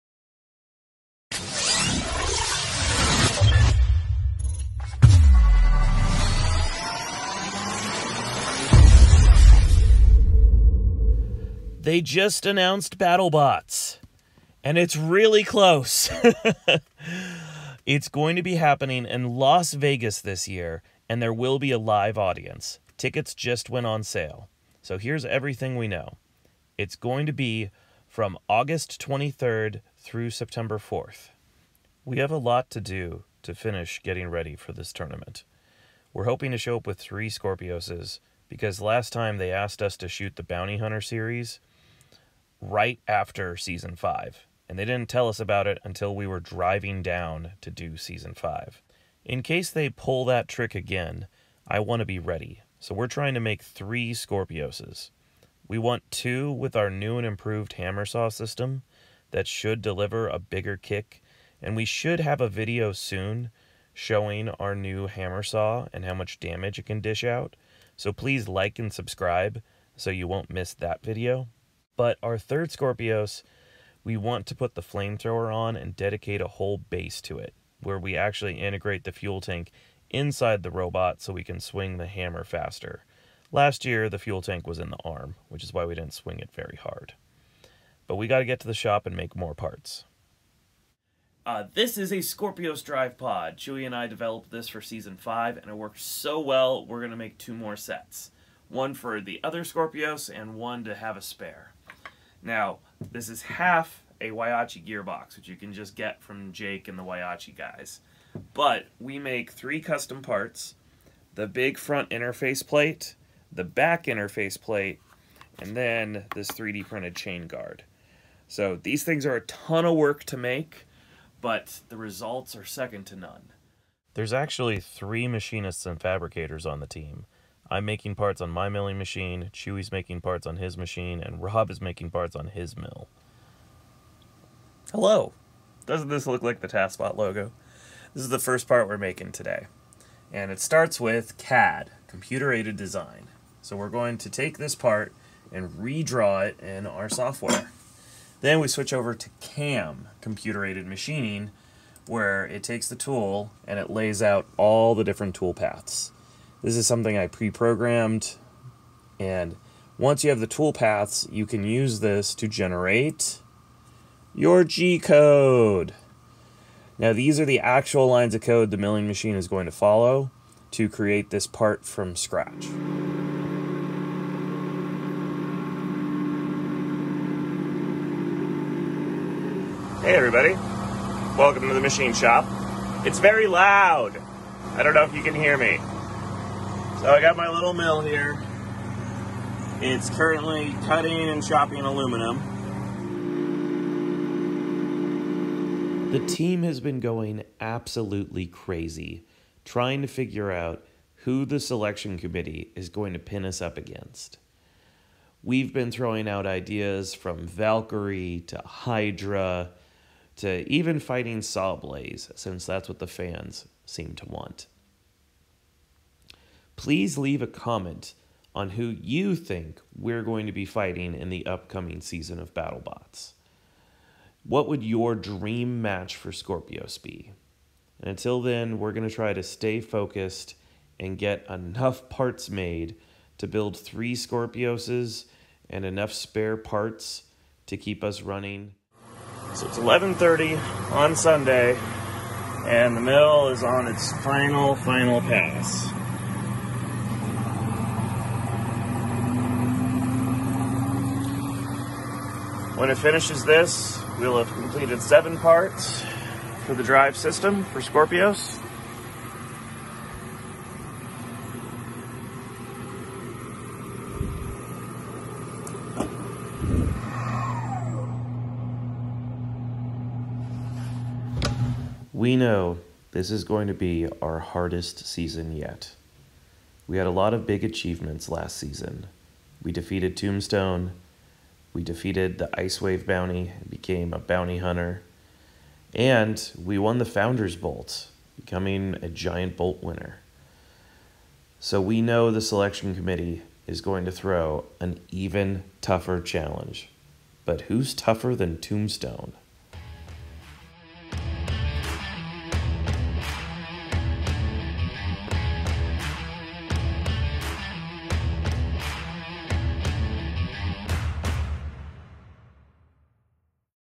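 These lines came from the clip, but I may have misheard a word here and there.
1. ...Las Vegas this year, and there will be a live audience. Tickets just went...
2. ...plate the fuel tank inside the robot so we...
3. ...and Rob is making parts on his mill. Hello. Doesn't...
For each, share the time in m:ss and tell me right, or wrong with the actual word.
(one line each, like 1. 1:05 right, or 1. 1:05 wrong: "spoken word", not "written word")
1. 0:19 right
2. 1:18 wrong: "integrate", not "plate"
3. 2:11 right.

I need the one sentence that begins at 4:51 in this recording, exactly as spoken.
So we know the selection committee is going to throw an even tougher challenge.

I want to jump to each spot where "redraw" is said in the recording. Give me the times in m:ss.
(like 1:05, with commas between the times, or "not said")
2:25.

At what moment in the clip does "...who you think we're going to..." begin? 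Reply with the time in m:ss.
3:38.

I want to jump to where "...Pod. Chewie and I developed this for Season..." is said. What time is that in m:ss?
1:33.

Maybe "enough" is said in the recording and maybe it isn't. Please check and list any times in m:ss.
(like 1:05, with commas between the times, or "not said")
3:51, 3:55.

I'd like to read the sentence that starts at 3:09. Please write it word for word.
It's currently cutting and chopping aluminum.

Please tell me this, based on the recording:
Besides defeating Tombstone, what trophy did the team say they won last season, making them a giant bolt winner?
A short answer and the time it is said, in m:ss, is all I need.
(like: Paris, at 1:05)
Founders Bolt, at 4:47.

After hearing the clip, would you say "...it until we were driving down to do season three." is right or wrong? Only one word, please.
wrong.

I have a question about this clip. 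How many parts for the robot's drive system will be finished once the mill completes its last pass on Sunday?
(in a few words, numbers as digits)
7.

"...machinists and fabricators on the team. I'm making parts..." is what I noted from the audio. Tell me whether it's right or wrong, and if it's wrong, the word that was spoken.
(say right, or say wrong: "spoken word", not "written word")
right.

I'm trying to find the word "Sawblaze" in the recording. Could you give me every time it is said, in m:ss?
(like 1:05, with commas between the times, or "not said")
3:31.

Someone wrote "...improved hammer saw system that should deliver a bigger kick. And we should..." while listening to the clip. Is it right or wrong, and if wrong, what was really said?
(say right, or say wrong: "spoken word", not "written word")
right.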